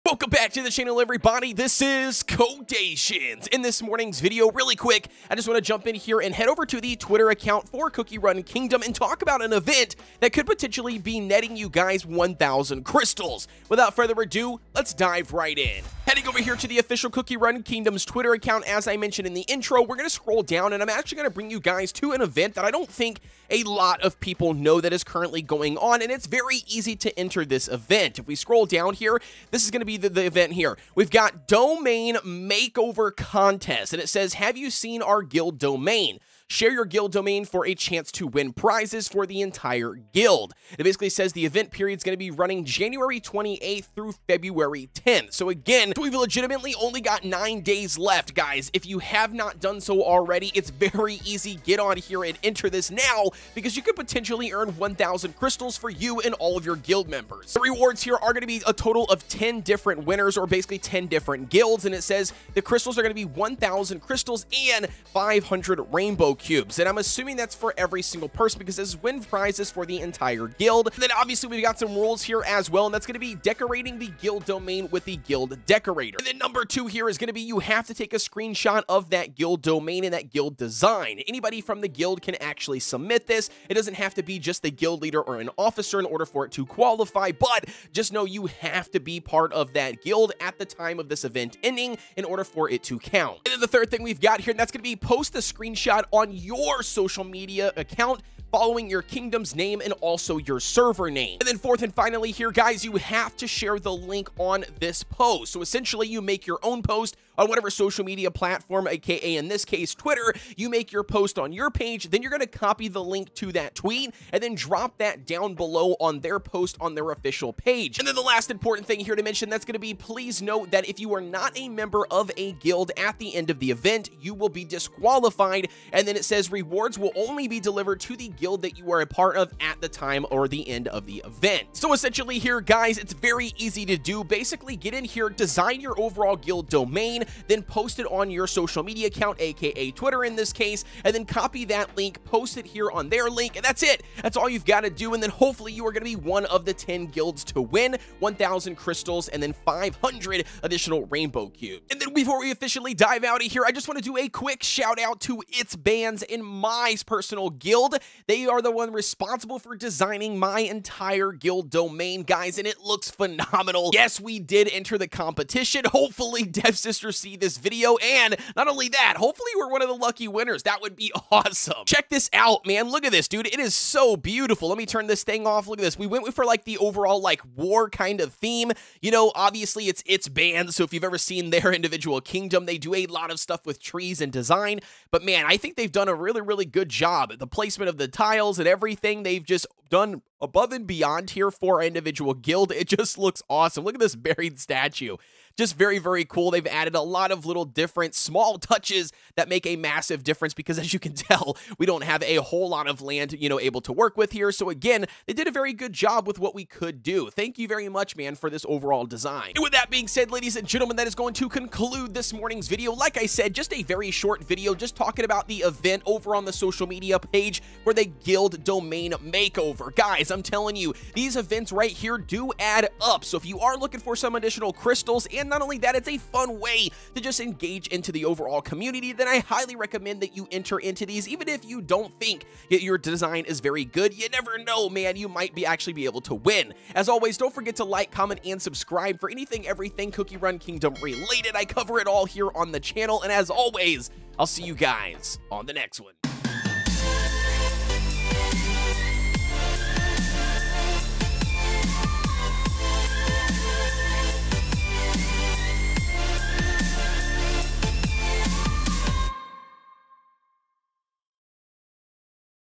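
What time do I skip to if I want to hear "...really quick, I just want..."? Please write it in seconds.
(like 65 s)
4 s.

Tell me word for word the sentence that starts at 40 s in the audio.
It basically says the event period is going to be running January 28th through February 10th.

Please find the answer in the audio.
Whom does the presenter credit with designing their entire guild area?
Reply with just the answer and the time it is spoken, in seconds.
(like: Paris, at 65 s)
It's Bands, at 155 s.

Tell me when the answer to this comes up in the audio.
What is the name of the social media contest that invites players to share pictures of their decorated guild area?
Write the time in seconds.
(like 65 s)
31 s.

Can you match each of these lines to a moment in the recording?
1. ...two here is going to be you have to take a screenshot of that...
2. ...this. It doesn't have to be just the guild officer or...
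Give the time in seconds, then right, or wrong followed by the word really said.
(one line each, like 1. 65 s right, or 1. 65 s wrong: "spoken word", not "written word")
1. 76 s right
2. 83 s wrong: "leader", not "officer".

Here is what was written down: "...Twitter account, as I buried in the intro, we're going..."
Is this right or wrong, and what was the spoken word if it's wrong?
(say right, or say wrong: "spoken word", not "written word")
wrong: "mentioned", not "buried".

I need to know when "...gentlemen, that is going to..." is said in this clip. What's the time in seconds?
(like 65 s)
210 s.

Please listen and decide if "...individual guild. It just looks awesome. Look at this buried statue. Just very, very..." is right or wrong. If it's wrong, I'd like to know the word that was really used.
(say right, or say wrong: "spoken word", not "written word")
right.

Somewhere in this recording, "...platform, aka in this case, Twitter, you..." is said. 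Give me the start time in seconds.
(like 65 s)
108 s.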